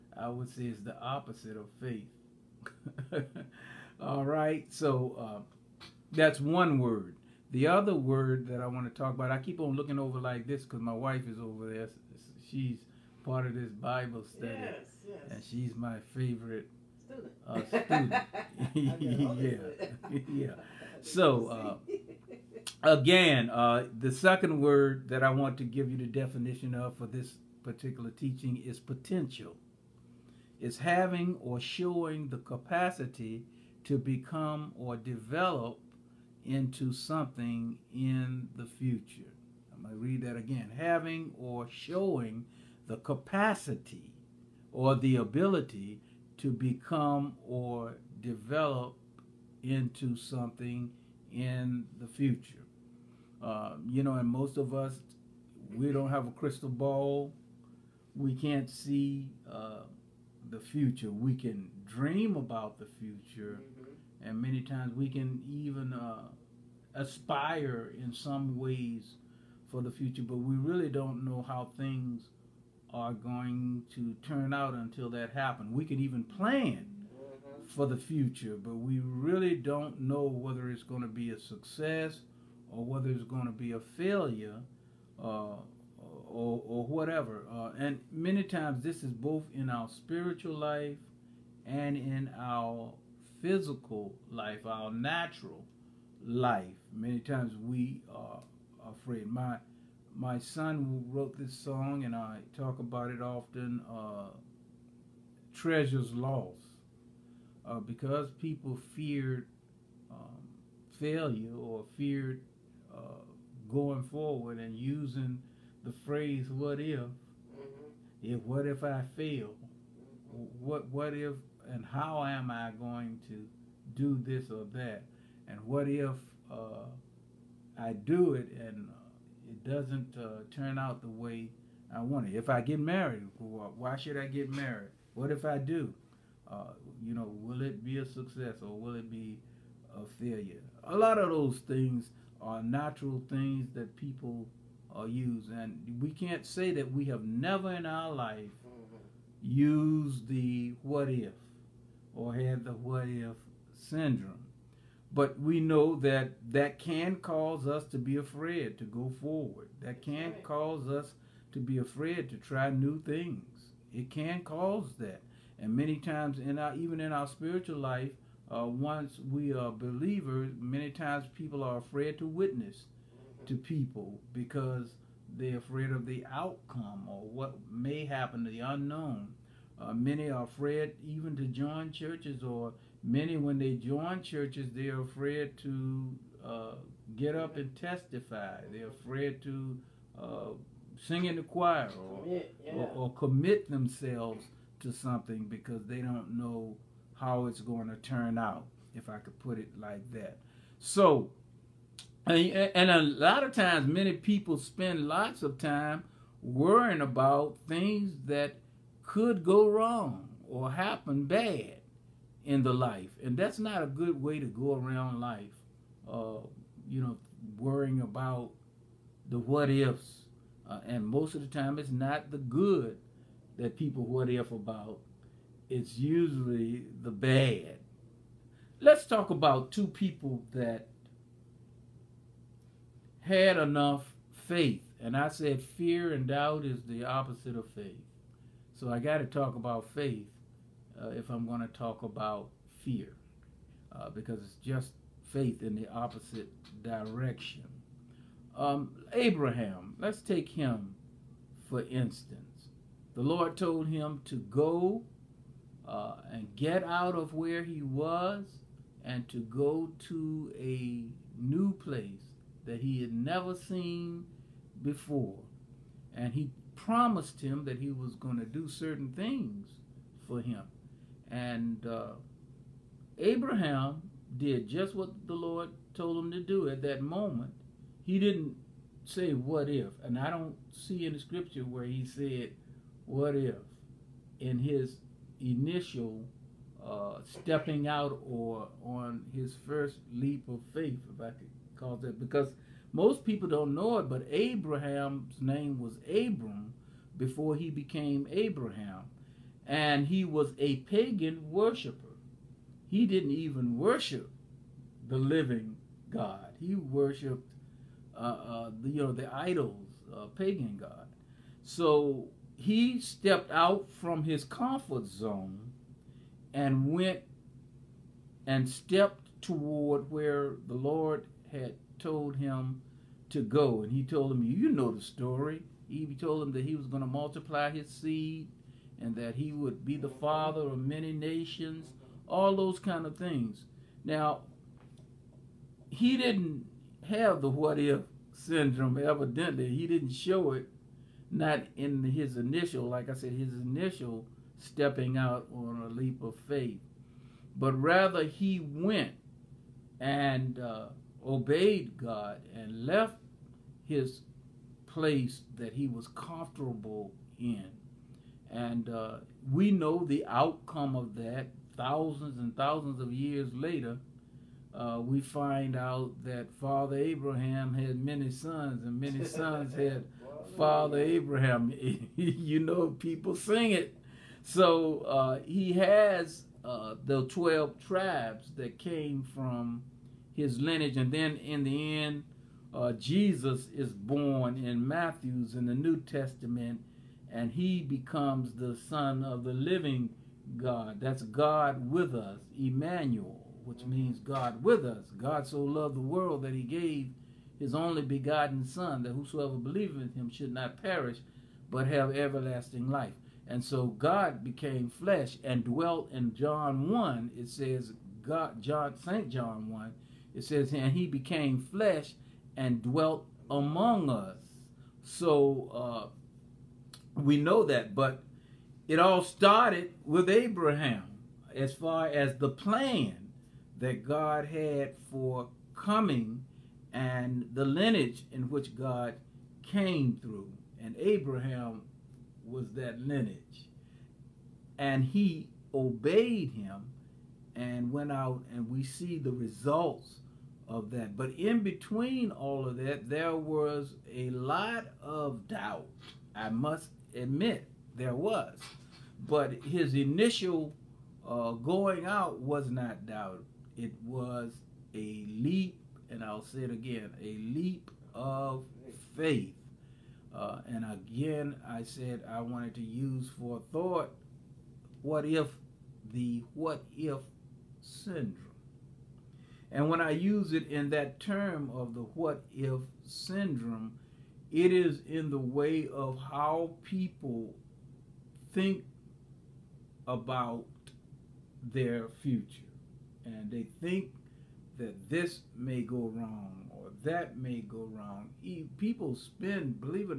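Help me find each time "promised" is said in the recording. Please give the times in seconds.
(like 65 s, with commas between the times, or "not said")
266 s.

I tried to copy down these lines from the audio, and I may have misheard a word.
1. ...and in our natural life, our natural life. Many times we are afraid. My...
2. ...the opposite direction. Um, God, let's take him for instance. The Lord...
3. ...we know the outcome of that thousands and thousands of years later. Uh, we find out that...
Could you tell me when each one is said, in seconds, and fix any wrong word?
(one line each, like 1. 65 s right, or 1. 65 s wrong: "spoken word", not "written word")
1. 91 s wrong: "physical", not "natural"
2. 245 s wrong: "Abraham", not "God"
3. 359 s right.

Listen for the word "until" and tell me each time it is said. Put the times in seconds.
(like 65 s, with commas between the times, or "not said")
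74 s.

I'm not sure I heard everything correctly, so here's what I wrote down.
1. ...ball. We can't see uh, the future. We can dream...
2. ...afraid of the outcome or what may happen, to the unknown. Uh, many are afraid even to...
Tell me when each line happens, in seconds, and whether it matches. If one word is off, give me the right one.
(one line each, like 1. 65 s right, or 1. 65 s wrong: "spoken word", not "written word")
1. 56 s right
2. 175 s right.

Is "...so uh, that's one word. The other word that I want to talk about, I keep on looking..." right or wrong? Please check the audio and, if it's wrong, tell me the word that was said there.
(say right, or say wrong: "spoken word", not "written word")
right.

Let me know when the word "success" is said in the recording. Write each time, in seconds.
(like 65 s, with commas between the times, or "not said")
81 s, 138 s.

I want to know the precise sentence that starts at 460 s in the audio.
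Uh, and again, I said I wanted to use for thought what if the what if syndrome.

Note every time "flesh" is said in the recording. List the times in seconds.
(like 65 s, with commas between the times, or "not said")
404 s, 411 s.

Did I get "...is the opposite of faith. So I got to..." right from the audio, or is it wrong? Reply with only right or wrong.
right.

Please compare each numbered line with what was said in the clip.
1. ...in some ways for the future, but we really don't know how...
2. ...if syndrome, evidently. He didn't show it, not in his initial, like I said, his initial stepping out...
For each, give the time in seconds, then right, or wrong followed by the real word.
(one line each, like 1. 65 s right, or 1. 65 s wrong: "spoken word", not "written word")
1. 68 s right
2. 337 s right.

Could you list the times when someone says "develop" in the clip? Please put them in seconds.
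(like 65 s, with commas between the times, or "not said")
34 s, 48 s.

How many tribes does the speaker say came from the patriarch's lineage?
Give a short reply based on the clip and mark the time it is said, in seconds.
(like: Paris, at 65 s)
12, at 377 s.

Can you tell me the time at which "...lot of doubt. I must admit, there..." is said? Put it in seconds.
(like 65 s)
444 s.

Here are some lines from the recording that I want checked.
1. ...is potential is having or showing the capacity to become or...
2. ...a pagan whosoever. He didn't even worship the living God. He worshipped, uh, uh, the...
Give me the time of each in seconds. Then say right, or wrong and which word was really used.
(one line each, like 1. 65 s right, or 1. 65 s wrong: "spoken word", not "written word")
1. 28 s right
2. 300 s wrong: "worshiper", not "whosoever".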